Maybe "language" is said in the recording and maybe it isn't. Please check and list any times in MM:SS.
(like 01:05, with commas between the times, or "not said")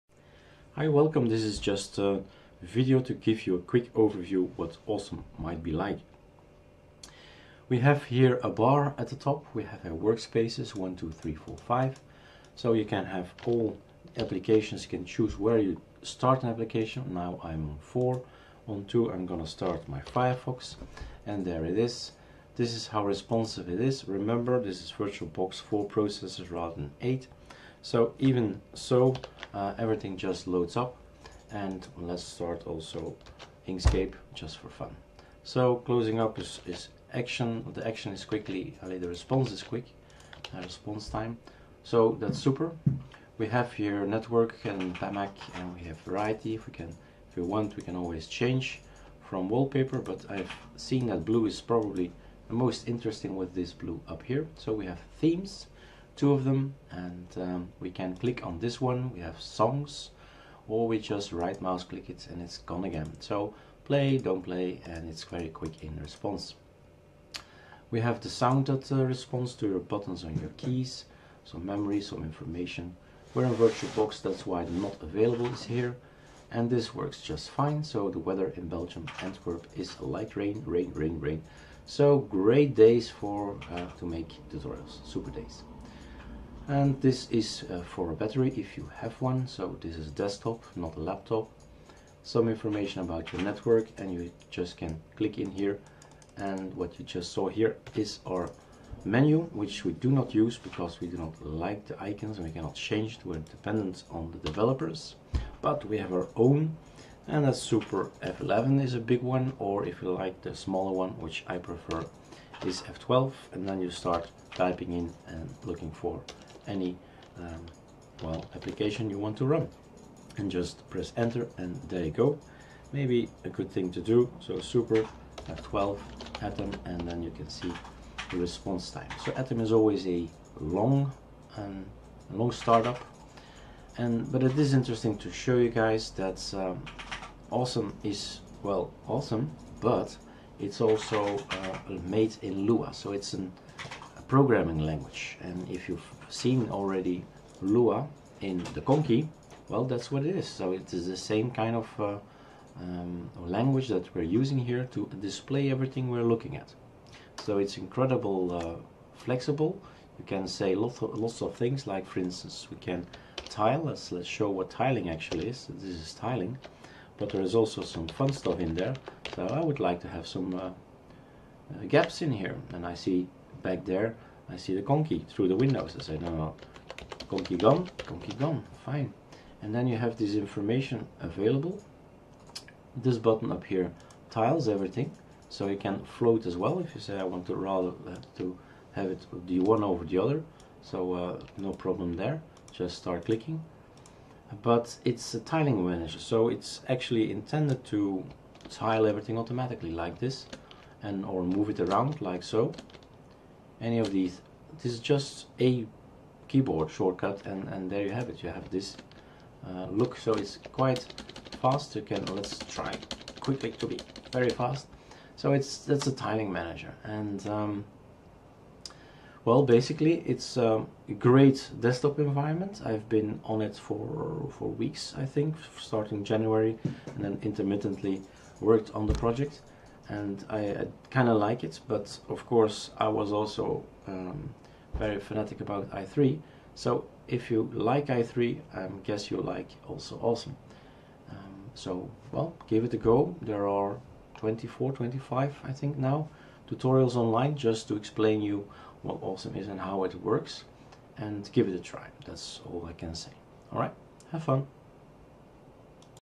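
02:24, 02:33.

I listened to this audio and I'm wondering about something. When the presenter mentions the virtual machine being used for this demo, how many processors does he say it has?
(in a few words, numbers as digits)
4.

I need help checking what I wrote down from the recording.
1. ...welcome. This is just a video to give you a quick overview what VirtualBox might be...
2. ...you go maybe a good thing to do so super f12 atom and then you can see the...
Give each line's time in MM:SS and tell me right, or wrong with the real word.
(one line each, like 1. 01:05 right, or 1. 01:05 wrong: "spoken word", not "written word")
1. 00:00 wrong: "Awesome", not "VirtualBox"
2. 02:02 right.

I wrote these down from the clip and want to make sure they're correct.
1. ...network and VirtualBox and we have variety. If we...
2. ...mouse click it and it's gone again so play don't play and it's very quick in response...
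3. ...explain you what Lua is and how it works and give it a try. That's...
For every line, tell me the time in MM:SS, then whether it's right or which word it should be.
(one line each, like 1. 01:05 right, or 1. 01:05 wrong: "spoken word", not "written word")
1. 00:44 wrong: "PAMAC", not "VirtualBox"
2. 01:01 right
3. 04:07 wrong: "Awesome", not "Lua".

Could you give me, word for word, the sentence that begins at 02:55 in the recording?
I say, no, no, conky gone, conky gone, fine.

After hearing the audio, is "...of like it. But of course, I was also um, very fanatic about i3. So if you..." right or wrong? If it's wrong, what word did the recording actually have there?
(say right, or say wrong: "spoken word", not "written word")
right.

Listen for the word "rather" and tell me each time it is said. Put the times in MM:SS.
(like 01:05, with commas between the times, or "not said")
00:26, 03:07.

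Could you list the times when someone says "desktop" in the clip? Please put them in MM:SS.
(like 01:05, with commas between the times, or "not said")
01:30, 03:41.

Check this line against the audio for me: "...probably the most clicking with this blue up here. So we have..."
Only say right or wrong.
wrong.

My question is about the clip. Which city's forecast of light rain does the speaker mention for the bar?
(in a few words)
Antwerp.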